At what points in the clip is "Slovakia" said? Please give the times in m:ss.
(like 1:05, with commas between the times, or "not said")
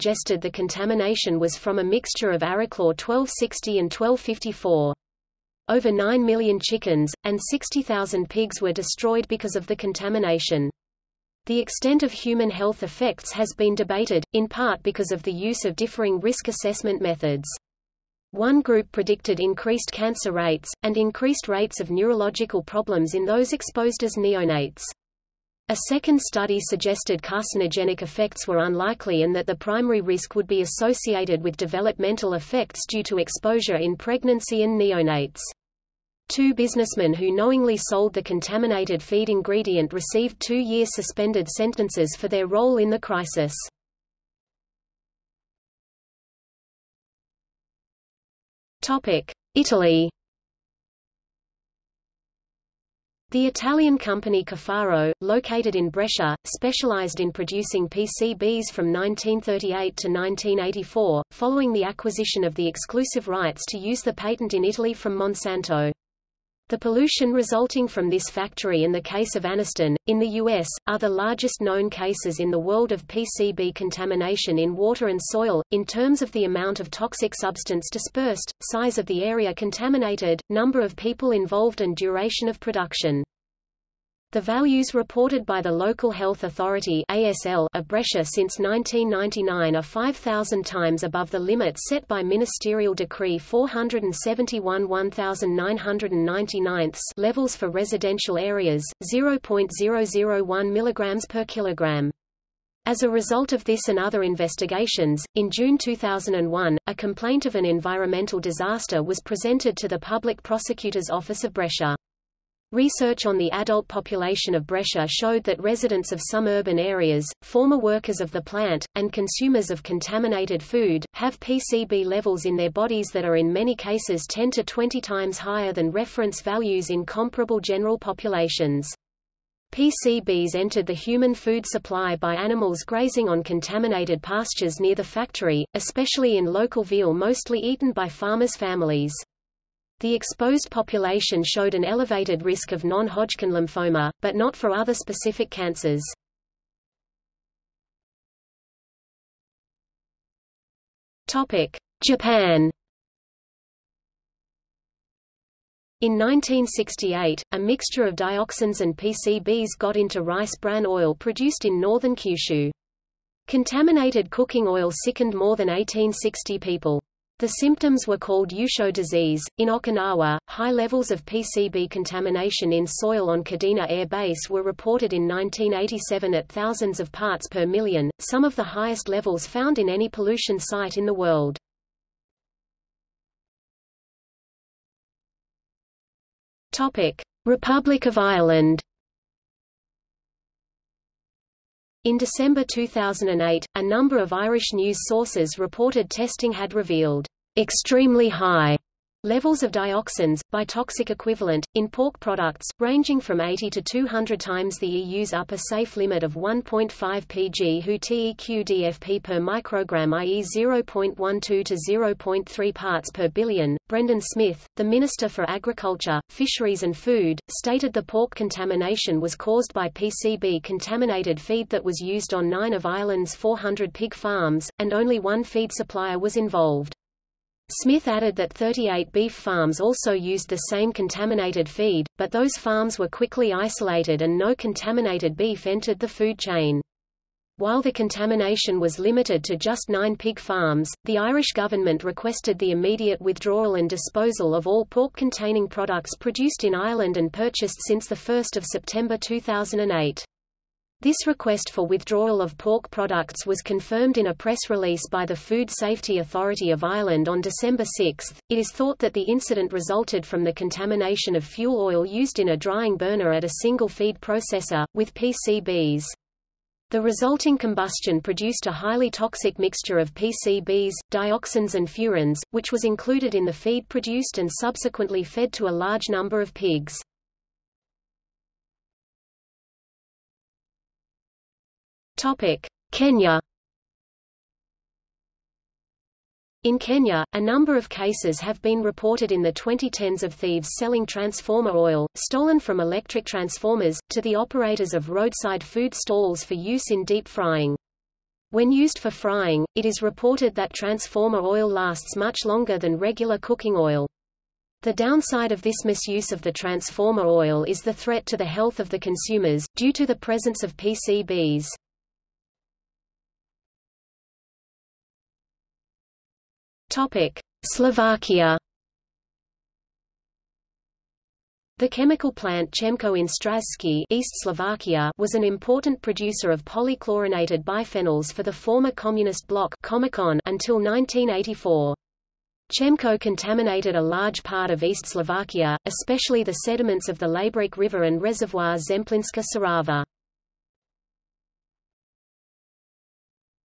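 5:17, 5:24, 5:35.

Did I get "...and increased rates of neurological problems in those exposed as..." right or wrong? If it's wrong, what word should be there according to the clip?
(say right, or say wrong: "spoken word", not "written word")
right.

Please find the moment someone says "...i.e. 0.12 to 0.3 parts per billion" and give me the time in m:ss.
3:30.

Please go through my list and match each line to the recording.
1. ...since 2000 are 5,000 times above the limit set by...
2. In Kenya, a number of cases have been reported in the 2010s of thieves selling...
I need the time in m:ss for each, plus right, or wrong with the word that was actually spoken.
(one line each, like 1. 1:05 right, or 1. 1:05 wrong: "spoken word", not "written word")
1. 1:28 wrong: "1999", not "2000"
2. 4:46 right.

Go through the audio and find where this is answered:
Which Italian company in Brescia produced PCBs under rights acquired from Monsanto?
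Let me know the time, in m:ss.
0:54.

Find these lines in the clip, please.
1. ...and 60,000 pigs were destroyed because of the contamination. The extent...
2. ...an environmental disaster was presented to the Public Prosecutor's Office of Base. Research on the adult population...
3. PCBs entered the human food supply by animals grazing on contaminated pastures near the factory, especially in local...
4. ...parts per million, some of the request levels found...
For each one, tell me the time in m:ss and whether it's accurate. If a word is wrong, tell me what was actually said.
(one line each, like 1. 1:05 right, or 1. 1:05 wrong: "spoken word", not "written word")
1. 0:07 right
2. 1:47 wrong: "Brescia", not "Base"
3. 2:09 right
4. 2:57 wrong: "highest", not "request".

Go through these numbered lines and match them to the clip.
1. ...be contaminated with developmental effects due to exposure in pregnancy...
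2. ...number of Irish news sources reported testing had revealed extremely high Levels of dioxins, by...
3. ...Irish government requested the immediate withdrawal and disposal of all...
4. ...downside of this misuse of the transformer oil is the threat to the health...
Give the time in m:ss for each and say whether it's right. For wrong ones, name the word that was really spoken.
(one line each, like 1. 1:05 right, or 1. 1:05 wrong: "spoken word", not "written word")
1. 0:30 wrong: "associated", not "contaminated"
2. 3:13 right
3. 4:01 right
4. 5:04 right.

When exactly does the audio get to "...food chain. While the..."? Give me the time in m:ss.
3:56.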